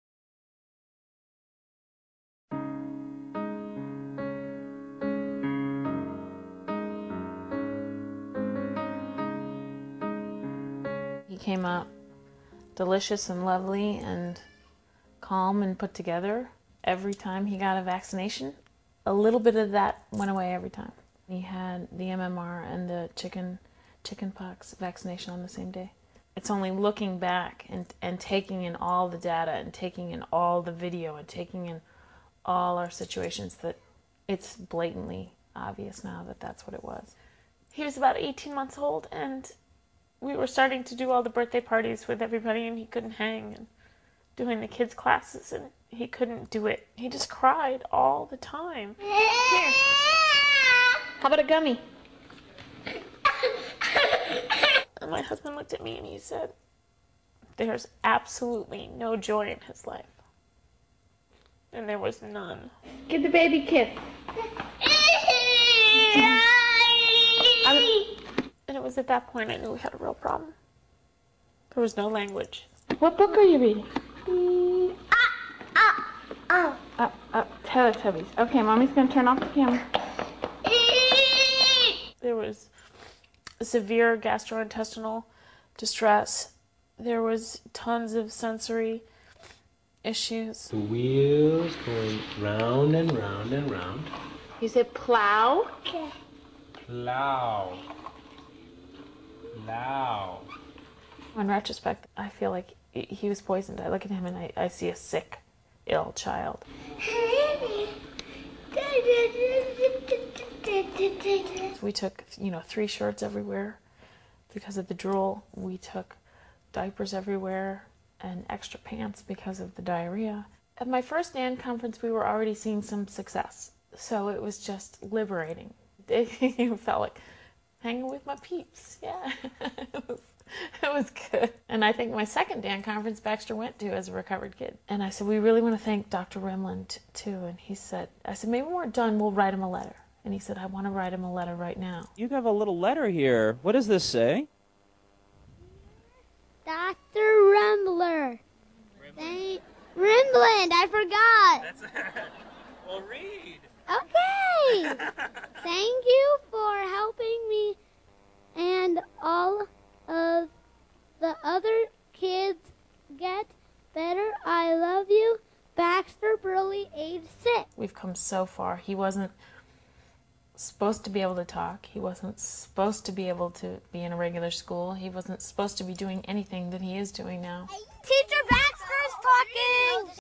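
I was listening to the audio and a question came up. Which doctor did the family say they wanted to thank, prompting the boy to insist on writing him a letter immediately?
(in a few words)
Dr. Rimland.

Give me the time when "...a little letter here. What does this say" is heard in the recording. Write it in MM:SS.
02:22.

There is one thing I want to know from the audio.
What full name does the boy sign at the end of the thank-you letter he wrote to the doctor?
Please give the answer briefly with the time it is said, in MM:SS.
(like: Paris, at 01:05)
Baxter Burley, at 02:45.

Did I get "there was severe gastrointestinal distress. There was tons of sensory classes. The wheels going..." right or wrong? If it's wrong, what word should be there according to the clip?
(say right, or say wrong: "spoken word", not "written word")
wrong: "issues", not "classes".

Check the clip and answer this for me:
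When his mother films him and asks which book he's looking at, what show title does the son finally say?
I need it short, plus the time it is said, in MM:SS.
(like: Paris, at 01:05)
Teletubbies, at 01:17.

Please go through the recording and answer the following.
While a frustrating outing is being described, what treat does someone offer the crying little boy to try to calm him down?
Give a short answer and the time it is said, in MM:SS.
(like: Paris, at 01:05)
A gummy, at 00:51.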